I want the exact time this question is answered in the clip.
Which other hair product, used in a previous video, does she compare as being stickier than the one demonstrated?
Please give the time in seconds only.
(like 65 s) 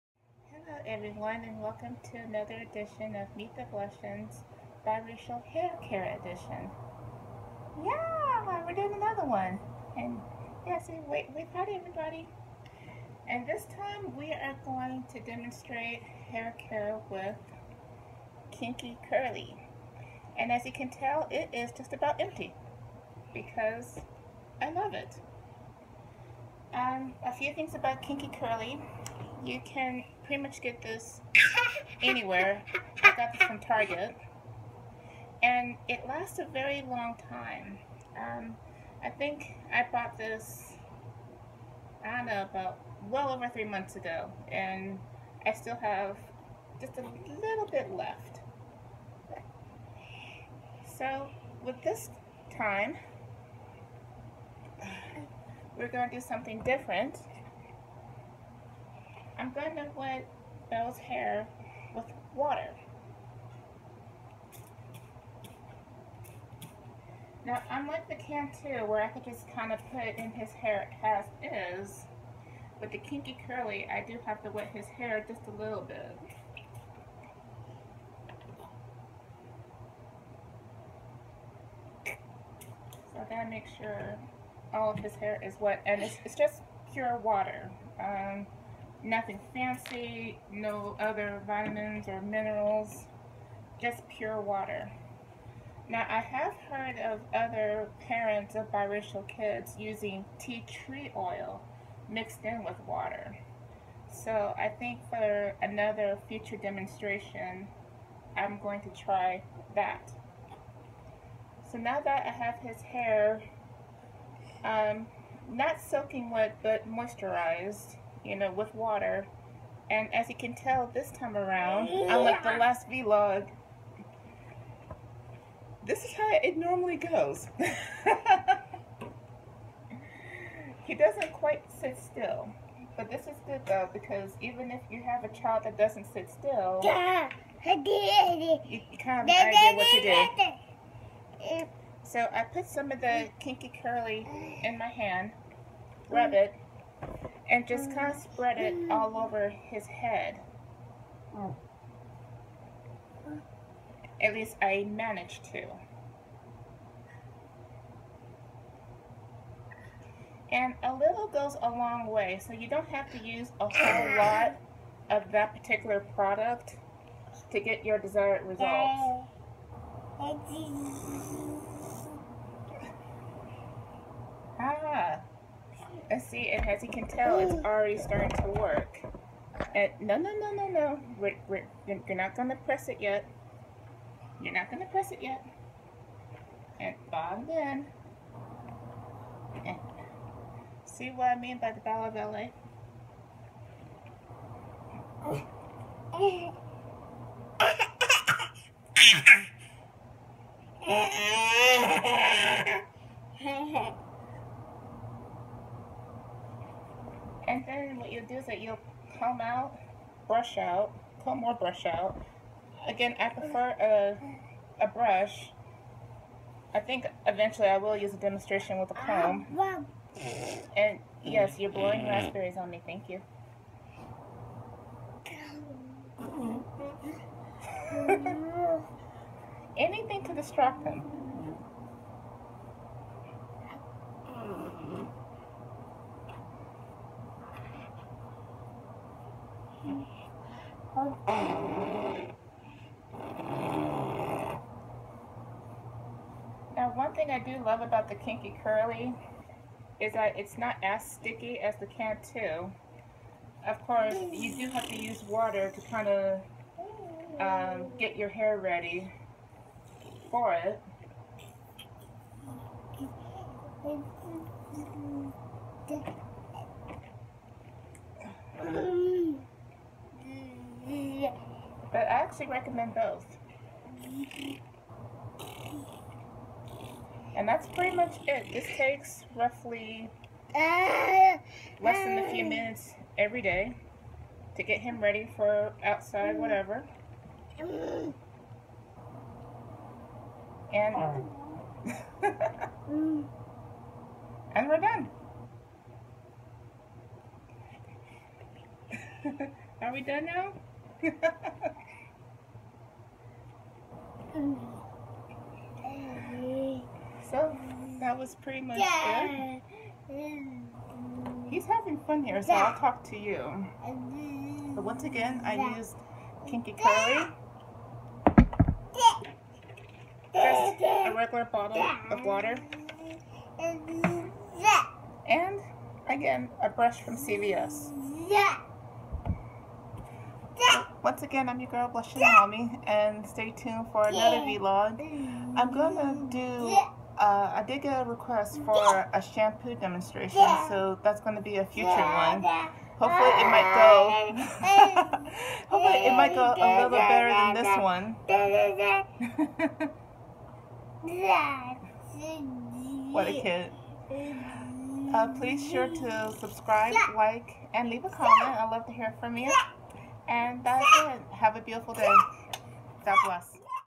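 251 s.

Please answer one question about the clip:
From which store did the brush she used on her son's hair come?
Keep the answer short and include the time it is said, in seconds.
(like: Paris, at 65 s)
CVS, at 327 s.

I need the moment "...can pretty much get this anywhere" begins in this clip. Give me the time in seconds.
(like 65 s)
29 s.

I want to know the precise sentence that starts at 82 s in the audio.
So I gotta make sure all of his hair is wet, and it's, it's just pure water.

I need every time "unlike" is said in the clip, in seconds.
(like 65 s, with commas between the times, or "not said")
67 s, 121 s.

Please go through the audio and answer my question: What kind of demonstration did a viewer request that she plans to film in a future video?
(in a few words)
shampoo demonstration.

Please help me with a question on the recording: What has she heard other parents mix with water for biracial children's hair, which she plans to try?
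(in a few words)
tea tree oil.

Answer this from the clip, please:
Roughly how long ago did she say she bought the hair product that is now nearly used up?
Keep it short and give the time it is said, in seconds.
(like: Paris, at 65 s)
over 3 months, at 43 s.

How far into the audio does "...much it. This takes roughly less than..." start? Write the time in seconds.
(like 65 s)
277 s.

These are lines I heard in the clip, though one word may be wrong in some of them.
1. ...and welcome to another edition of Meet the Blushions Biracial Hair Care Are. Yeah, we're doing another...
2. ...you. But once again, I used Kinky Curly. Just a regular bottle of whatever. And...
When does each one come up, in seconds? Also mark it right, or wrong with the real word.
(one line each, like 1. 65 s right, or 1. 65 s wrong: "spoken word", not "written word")
1. 1 s wrong: "Edition", not "Are"
2. 313 s wrong: "water", not "whatever".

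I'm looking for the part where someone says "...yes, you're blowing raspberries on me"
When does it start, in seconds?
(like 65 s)
221 s.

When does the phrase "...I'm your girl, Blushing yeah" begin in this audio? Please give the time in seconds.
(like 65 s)
331 s.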